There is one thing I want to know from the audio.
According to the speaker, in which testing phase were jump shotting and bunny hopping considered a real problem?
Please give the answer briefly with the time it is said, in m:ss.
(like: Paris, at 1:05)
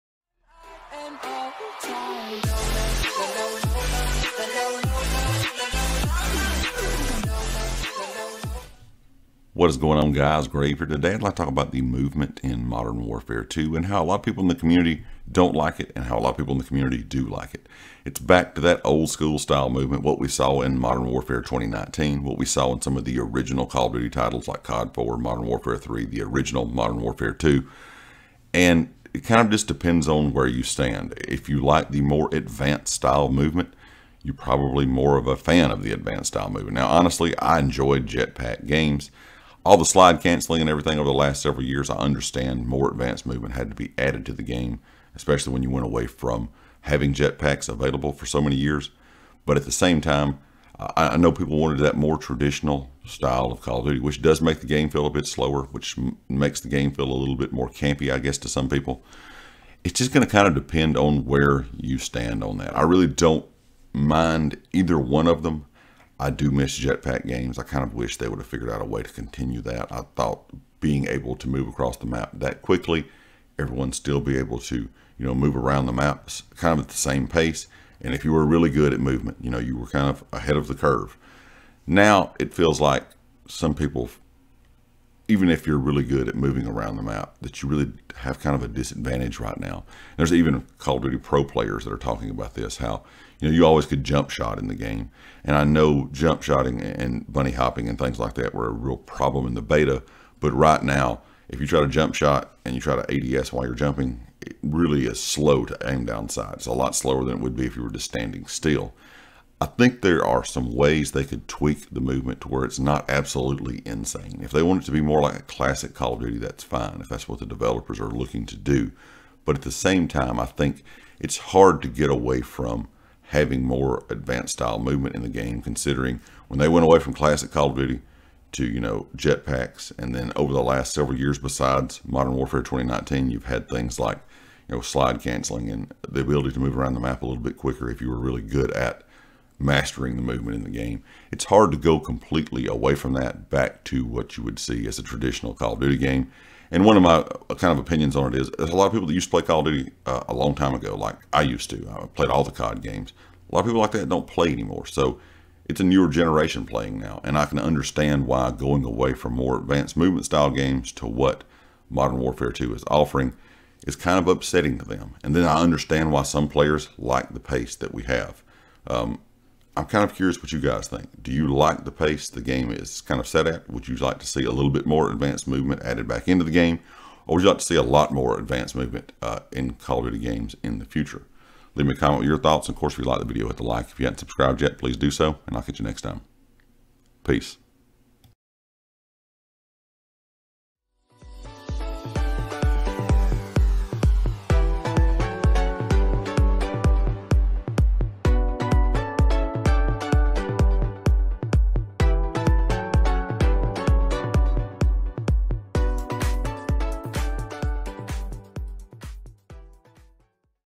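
the beta, at 1:39.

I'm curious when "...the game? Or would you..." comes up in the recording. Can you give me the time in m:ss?
2:56.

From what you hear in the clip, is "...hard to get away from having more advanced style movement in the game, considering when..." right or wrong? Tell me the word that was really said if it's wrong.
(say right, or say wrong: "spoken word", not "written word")
right.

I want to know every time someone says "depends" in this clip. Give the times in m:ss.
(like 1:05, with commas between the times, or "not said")
0:29, 1:00.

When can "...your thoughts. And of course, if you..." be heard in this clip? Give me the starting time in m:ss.
3:02.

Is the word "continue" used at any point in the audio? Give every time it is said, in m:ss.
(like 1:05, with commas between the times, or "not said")
1:09.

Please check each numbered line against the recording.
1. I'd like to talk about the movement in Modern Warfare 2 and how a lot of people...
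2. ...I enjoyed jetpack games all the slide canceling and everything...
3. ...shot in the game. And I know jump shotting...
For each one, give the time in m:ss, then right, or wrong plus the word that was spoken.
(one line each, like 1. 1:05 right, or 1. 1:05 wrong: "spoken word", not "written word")
1. 0:11 right
2. 0:37 right
3. 1:34 right.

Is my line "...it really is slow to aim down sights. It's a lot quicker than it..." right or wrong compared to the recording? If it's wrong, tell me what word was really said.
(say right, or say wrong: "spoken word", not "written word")
wrong: "slower", not "quicker".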